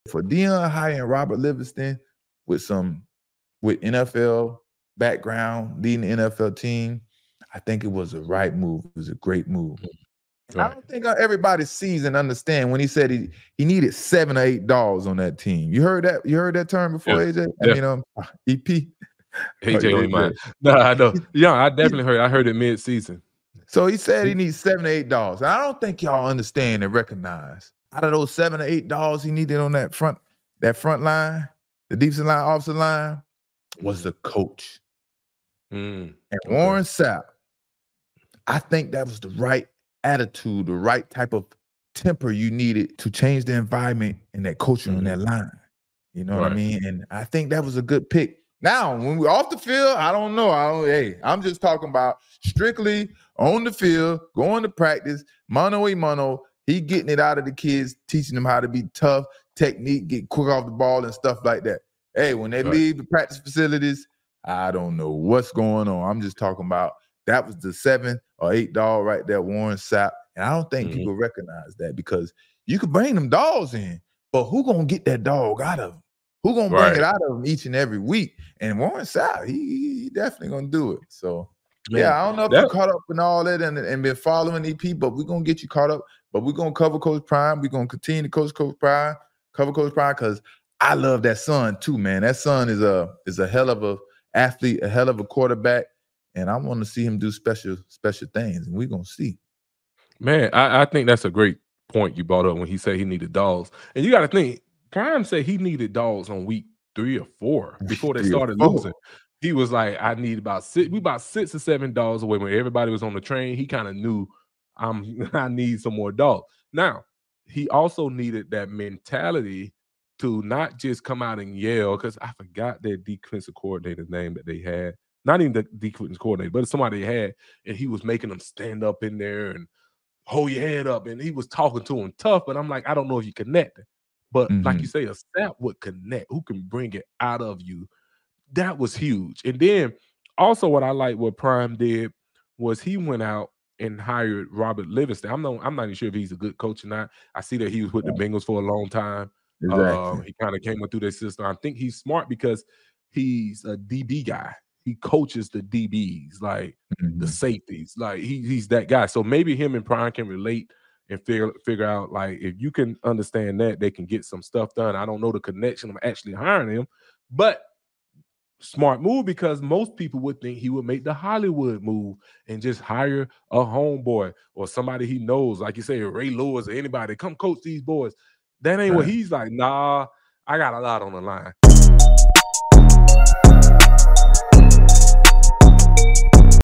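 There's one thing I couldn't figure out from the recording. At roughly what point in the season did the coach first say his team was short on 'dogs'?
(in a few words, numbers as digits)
week three or four.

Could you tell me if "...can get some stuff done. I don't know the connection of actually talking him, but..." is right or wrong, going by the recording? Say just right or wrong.
wrong.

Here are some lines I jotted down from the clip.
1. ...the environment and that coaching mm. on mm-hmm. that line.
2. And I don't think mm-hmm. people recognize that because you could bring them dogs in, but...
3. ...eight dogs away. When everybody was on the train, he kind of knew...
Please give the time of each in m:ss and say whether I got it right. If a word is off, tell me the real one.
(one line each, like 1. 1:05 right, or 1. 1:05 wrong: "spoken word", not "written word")
1. 0:43 right
2. 1:10 right
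3. 1:51 wrong: "seven", not "eight".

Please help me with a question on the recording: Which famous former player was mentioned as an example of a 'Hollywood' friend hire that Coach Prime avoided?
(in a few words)
Ray Lewis.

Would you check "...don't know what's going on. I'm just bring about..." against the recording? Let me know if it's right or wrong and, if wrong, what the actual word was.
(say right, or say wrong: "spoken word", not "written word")
wrong: "talking", not "bring".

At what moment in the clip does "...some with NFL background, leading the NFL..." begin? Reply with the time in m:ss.
0:02.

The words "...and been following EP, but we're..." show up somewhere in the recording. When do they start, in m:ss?
1:23.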